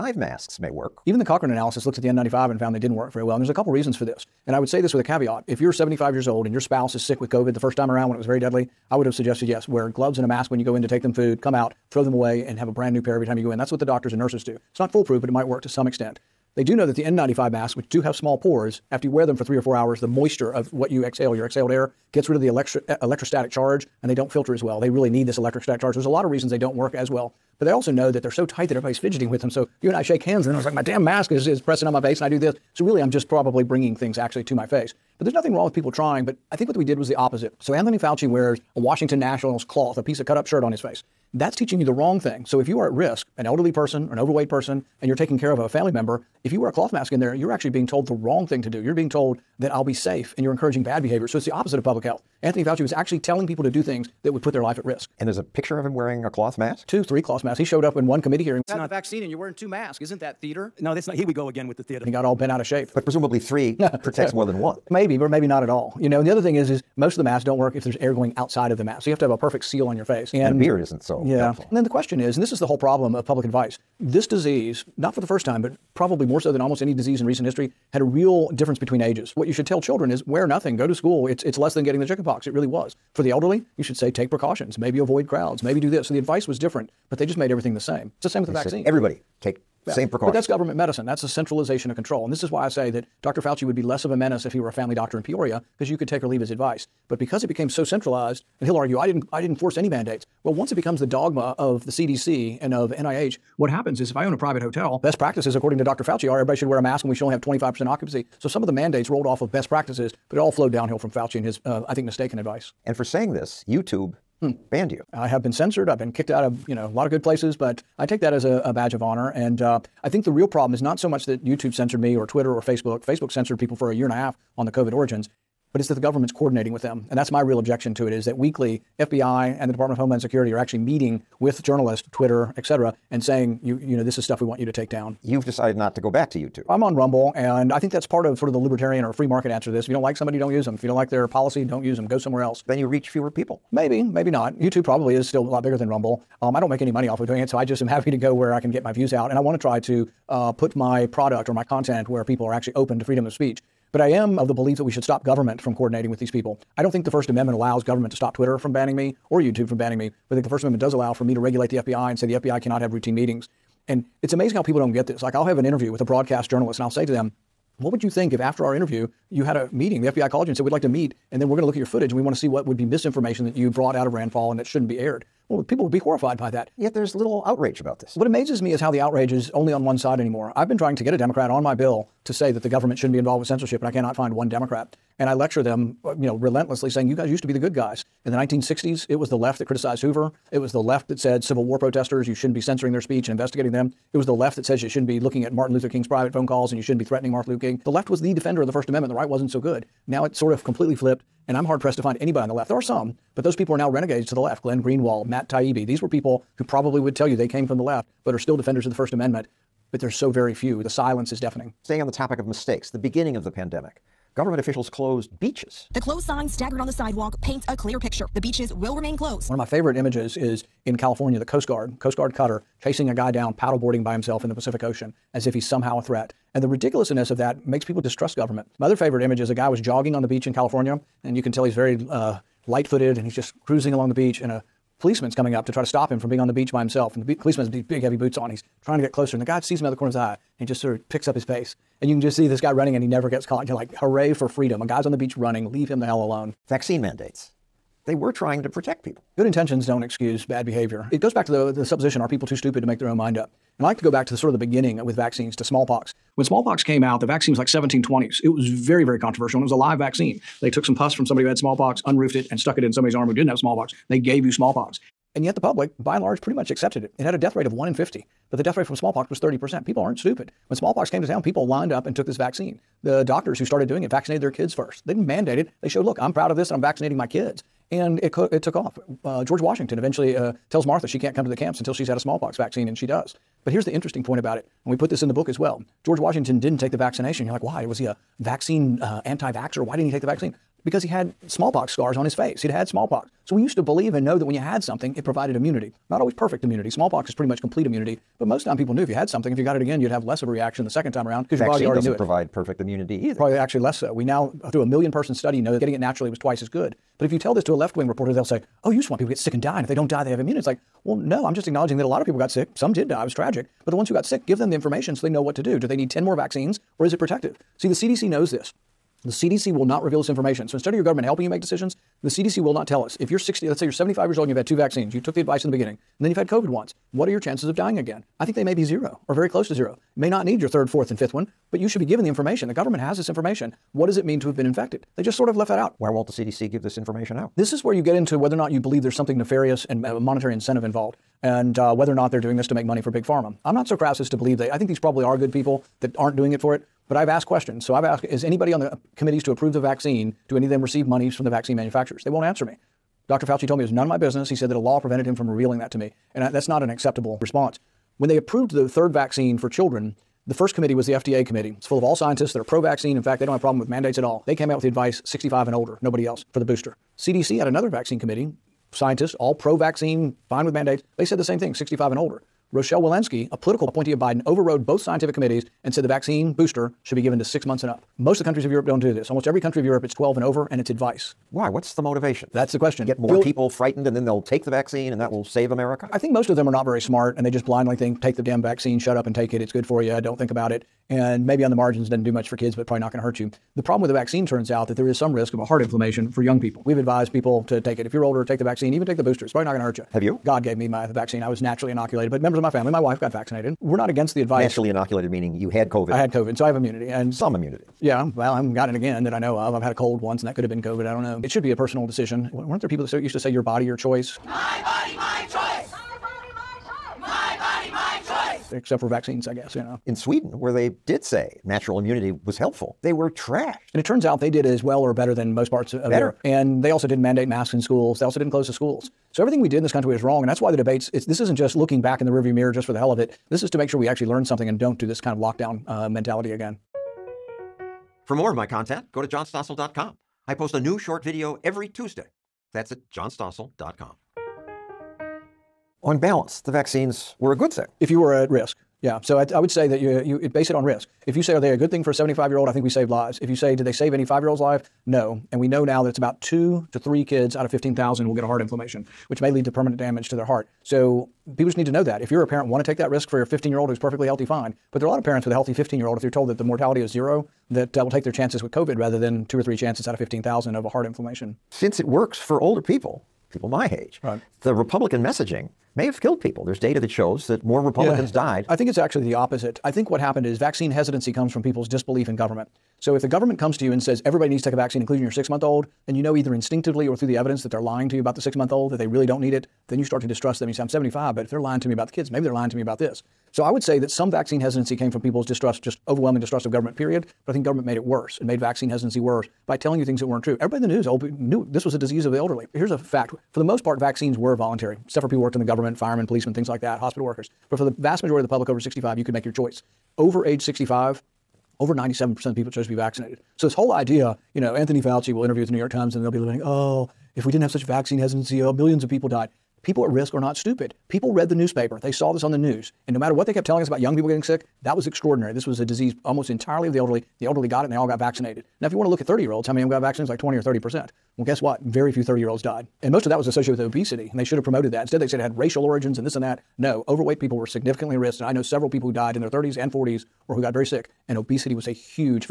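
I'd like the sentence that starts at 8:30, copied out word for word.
Over age 65, over 97% of people chose to be vaccinated.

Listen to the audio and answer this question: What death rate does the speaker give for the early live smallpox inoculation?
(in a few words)
1 in 50.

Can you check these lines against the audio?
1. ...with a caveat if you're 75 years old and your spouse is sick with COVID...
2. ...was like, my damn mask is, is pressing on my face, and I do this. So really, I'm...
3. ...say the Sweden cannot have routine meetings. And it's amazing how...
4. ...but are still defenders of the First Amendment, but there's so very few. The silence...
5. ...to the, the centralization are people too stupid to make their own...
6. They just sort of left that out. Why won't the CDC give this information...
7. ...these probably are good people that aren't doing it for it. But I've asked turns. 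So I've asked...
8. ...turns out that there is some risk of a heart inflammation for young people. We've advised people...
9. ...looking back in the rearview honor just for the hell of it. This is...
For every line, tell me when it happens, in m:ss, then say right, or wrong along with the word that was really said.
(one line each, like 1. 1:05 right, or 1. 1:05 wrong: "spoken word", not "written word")
1. 0:04 right
2. 0:30 right
3. 2:42 wrong: "FBI", not "Sweden"
4. 3:28 right
5. 4:11 wrong: "supposition", not "centralization"
6. 5:35 right
7. 5:44 wrong: "questions", not "turns"
8. 6:34 right
9. 7:11 wrong: "mirror", not "honor".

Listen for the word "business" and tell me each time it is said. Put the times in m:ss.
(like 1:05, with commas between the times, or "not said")
5:54.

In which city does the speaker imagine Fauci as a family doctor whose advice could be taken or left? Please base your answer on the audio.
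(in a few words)
Peoria.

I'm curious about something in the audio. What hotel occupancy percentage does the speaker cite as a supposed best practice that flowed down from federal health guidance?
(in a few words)
25%.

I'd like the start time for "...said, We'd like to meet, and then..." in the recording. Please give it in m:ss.
2:50.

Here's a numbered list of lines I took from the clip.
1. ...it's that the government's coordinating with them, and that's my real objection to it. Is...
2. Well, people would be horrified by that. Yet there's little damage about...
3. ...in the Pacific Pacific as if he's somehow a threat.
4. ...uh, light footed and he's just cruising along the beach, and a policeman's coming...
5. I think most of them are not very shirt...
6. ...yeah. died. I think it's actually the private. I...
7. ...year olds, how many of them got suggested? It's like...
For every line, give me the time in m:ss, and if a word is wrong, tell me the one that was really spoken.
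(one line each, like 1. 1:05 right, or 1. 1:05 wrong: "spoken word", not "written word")
1. 2:05 right
2. 2:55 wrong: "outrage", not "damage"
3. 3:44 wrong: "Ocean", not "Pacific"
4. 3:52 right
5. 6:26 wrong: "smart", not "shirt"
6. 7:58 wrong: "opposite", not "private"
7. 8:49 wrong: "vaccinated", not "suggested".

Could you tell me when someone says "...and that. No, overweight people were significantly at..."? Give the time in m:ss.
8:56.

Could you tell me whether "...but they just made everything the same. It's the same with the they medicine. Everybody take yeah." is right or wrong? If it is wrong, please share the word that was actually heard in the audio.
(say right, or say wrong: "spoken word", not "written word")
wrong: "vaccine", not "medicine".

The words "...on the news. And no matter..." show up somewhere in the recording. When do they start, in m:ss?
8:42.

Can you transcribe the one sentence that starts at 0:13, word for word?
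That's what the doctors and nurses do.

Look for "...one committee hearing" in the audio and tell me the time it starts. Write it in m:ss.
0:58.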